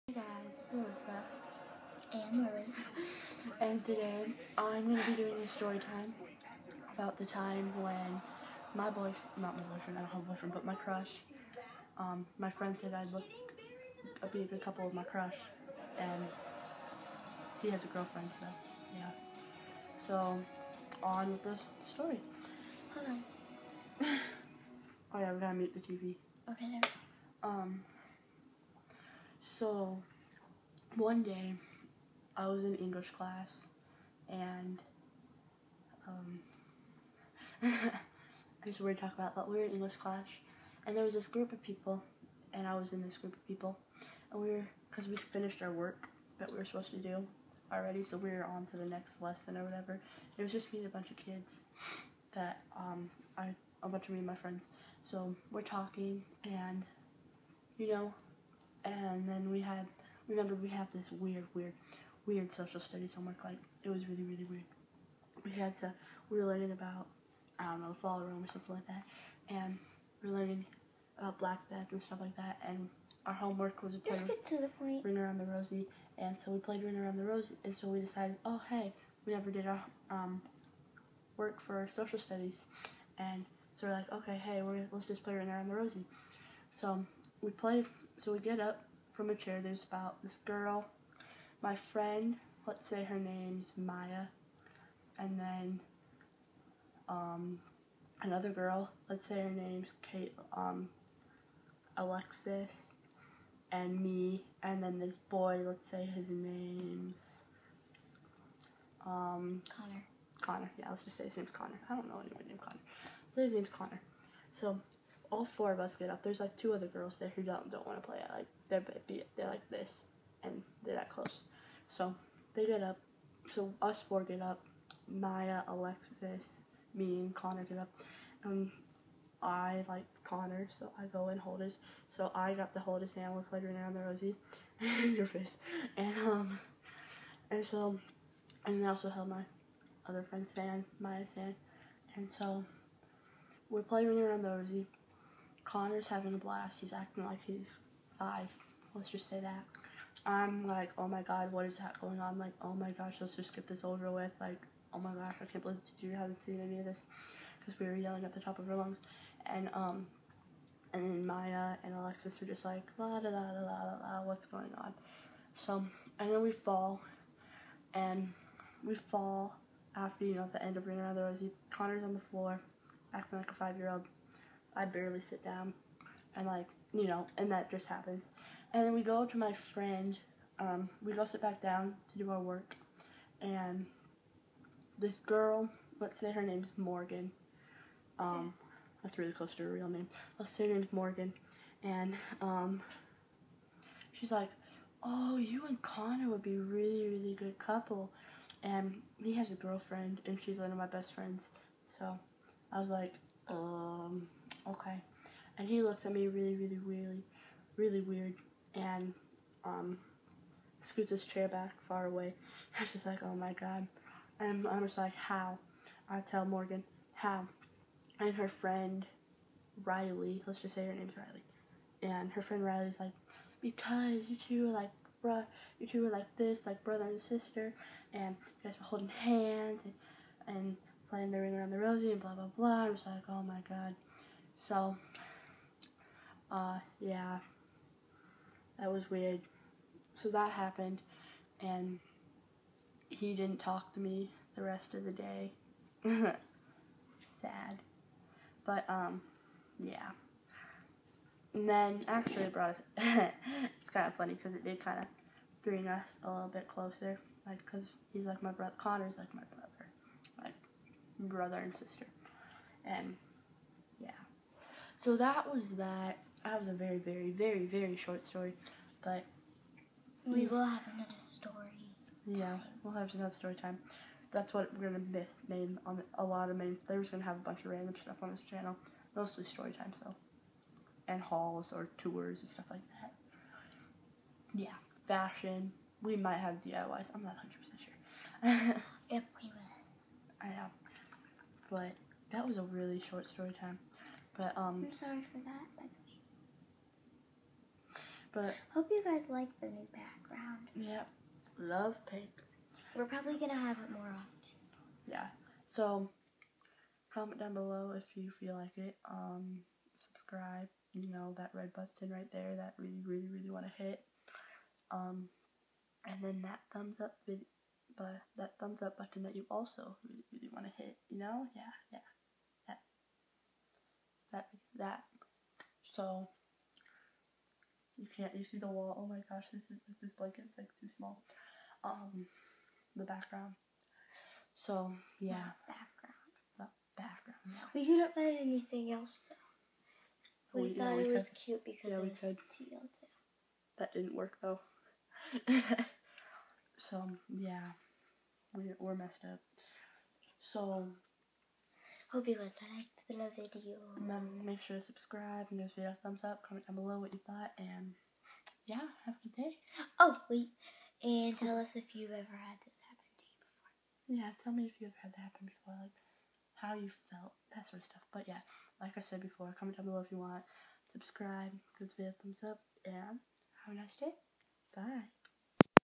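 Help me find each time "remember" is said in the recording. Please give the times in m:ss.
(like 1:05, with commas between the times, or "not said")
1:00, 5:53.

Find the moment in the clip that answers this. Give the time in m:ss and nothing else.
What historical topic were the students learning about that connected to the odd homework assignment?
1:11.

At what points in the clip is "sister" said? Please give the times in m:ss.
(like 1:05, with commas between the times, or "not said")
3:47, 4:21.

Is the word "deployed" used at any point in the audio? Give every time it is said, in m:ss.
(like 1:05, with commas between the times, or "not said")
not said.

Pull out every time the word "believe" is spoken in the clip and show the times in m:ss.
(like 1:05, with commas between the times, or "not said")
2:35.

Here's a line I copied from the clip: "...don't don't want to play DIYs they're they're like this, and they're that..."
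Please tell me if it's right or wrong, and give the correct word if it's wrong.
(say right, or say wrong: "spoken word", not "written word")
wrong: "Like", not "DIYs".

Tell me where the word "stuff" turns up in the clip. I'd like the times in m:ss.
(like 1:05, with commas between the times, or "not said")
1:12, 4:38, 4:42, 6:07.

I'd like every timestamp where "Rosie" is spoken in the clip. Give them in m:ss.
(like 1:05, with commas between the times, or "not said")
2:14, 2:24, 2:51.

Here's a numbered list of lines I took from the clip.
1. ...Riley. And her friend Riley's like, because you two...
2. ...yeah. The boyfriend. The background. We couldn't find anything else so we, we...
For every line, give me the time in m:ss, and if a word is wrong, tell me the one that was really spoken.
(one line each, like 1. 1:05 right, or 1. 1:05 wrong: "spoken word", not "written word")
1. 3:41 right
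2. 5:35 wrong: "background", not "boyfriend".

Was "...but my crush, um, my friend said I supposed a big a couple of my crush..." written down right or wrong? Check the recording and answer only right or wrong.
wrong.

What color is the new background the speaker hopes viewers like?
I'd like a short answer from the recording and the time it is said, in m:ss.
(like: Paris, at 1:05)
Pink, at 5:02.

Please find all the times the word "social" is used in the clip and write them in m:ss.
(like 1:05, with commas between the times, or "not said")
1:02, 1:21.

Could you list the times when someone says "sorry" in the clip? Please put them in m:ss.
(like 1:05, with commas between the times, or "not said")
4:54.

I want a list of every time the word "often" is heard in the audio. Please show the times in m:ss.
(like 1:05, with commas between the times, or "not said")
5:04.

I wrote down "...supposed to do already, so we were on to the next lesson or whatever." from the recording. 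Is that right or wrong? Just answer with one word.
right.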